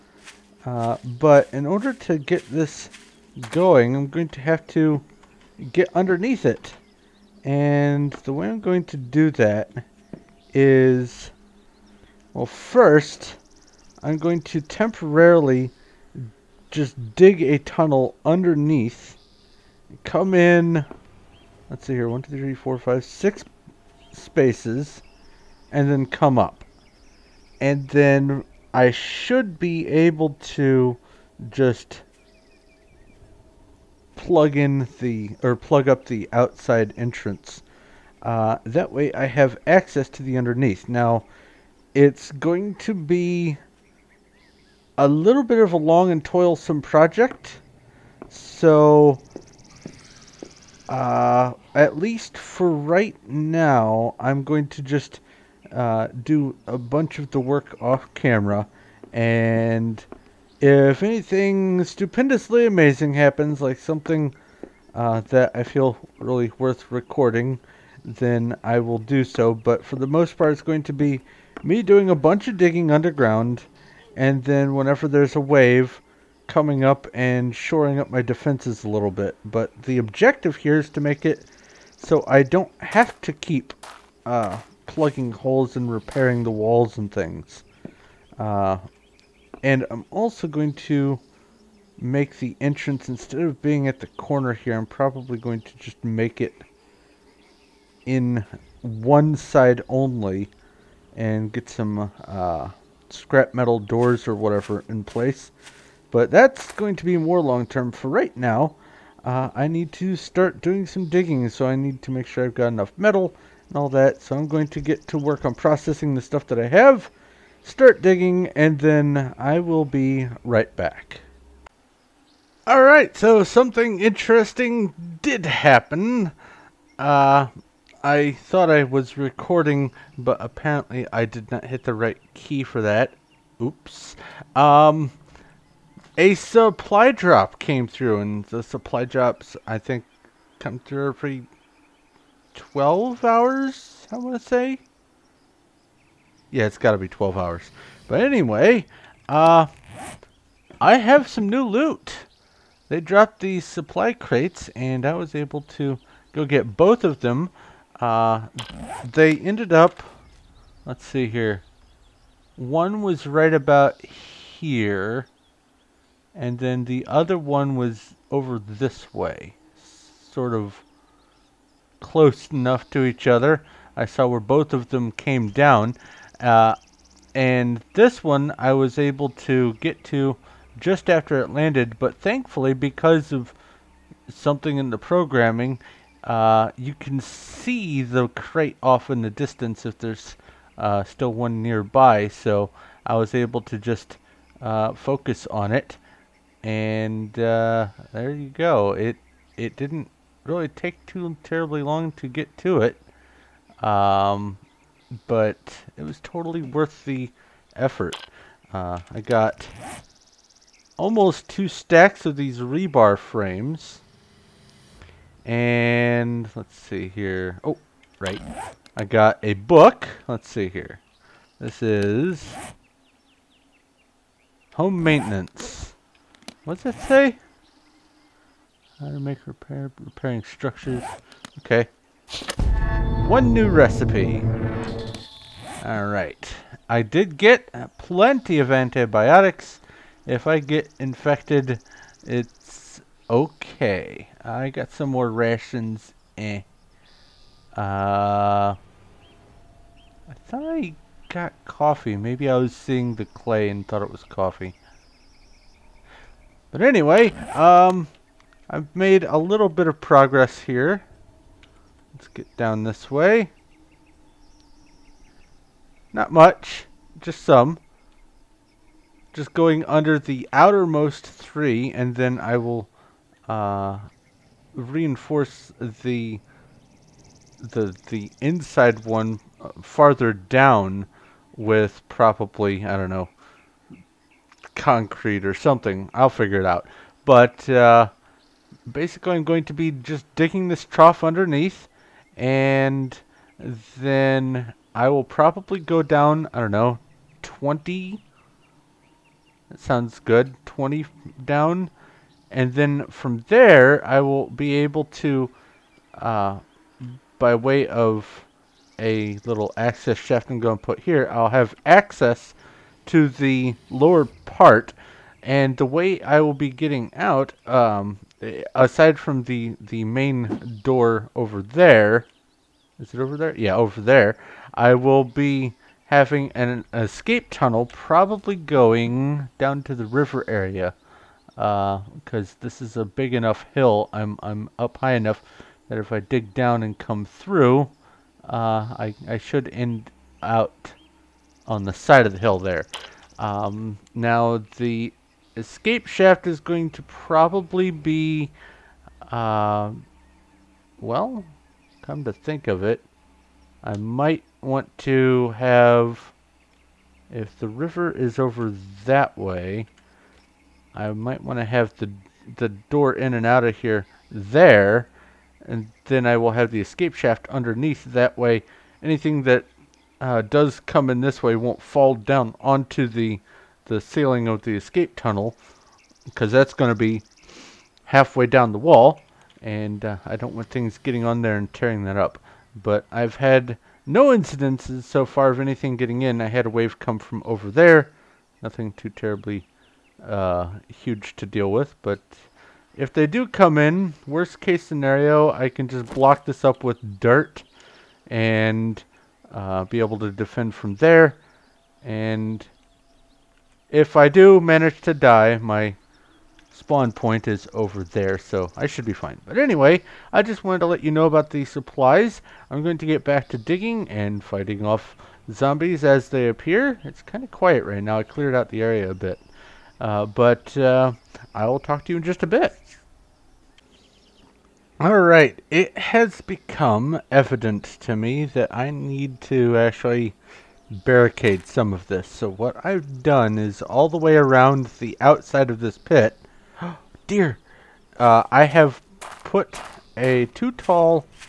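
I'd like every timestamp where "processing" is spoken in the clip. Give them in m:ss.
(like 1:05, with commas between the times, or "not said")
1:55.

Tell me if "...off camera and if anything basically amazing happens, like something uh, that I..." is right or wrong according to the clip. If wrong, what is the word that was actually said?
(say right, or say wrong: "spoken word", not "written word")
wrong: "stupendously", not "basically".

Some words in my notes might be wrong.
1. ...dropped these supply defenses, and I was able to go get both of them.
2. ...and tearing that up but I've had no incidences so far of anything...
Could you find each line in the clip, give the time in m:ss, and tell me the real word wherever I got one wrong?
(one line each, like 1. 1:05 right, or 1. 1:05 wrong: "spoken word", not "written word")
1. 2:32 wrong: "crates", not "defenses"
2. 6:21 right.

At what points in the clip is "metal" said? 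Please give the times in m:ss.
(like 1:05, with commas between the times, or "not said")
1:43, 1:52.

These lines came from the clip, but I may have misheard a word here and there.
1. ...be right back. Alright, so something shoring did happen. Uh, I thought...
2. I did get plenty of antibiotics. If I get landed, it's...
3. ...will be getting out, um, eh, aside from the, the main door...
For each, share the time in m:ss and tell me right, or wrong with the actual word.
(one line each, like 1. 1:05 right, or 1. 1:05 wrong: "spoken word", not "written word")
1. 1:59 wrong: "interesting", not "shoring"
2. 3:56 wrong: "infected", not "landed"
3. 5:16 right.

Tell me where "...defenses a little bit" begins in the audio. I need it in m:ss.
1:18.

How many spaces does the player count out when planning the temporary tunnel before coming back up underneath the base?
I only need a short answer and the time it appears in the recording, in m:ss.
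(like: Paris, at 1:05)
6, at 0:23.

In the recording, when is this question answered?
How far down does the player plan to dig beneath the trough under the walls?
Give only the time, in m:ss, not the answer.
5:00.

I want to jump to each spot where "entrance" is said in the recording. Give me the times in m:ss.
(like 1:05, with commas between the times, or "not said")
0:36, 1:32.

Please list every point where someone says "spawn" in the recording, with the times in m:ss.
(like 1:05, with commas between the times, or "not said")
6:46.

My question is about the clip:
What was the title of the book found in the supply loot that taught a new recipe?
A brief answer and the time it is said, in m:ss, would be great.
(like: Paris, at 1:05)
Home maintenance, at 3:44.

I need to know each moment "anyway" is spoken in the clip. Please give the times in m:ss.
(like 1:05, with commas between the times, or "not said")
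2:28, 4:16, 6:49.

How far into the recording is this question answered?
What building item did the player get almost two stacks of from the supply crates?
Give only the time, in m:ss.
3:32.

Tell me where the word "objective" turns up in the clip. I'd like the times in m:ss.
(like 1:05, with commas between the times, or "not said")
1:19.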